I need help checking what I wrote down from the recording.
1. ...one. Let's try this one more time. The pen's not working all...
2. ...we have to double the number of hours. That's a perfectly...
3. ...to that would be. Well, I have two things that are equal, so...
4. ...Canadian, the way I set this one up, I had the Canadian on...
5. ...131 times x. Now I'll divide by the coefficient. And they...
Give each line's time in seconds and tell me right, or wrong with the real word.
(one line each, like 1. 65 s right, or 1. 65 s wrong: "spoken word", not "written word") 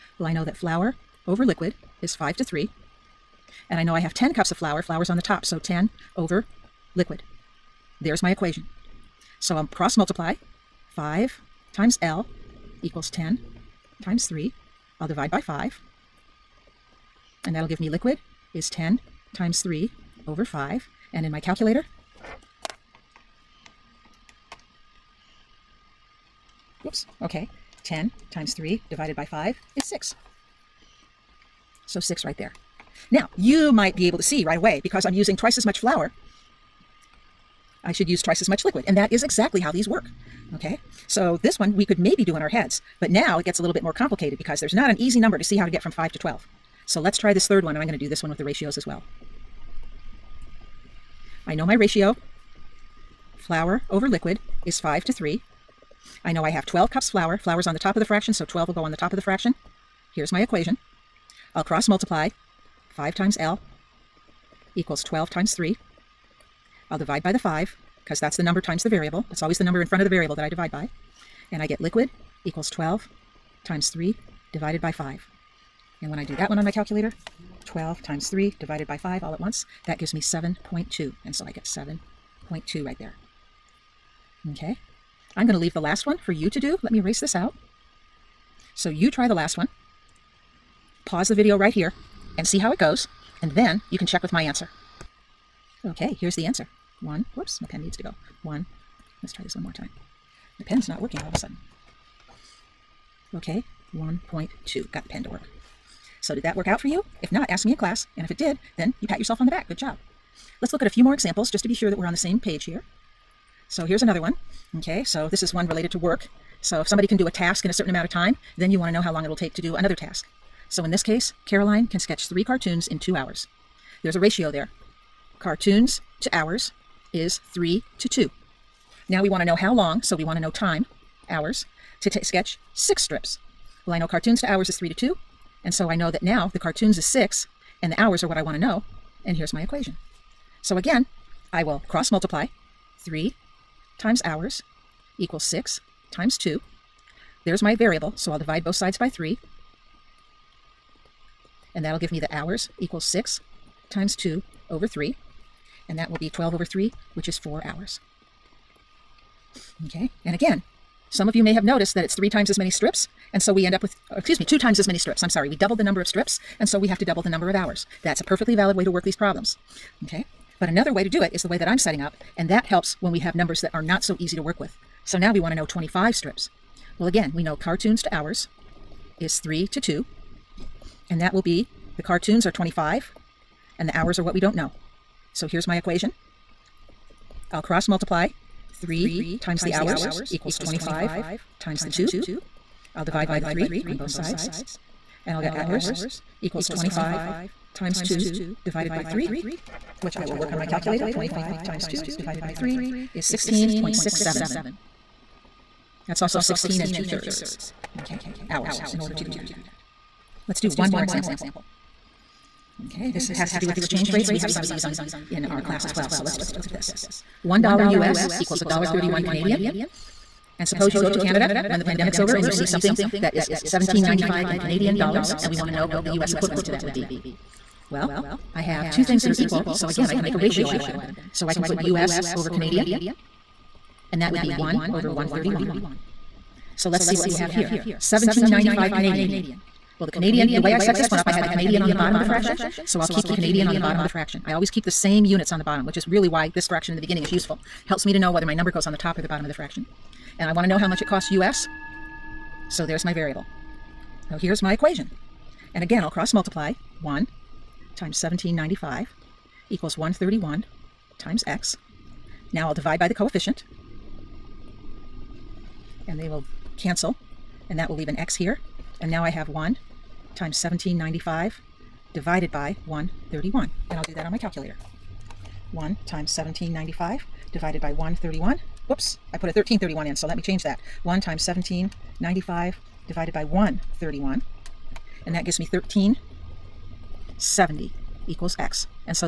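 1. 98 s right
2. 166 s right
3. 226 s right
4. 240 s right
5. 259 s right.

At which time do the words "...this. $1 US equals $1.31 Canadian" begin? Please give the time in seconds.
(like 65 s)
216 s.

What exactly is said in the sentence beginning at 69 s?
That's always the number in front of the variable that I divide by.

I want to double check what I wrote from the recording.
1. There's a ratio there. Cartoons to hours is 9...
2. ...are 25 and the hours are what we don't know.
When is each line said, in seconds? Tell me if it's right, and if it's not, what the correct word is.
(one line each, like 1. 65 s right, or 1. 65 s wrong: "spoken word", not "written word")
1. 124 s wrong: "3", not "9"
2. 182 s right.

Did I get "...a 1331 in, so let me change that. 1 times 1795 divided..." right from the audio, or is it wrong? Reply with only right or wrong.
right.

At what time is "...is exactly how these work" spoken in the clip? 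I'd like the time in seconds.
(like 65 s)
39 s.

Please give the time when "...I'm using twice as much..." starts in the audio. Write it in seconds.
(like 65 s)
35 s.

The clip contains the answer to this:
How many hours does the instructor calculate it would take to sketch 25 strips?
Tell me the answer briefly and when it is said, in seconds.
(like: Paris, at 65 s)
16.67, at 203 s.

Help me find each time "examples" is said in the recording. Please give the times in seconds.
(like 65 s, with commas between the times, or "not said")
111 s, 211 s.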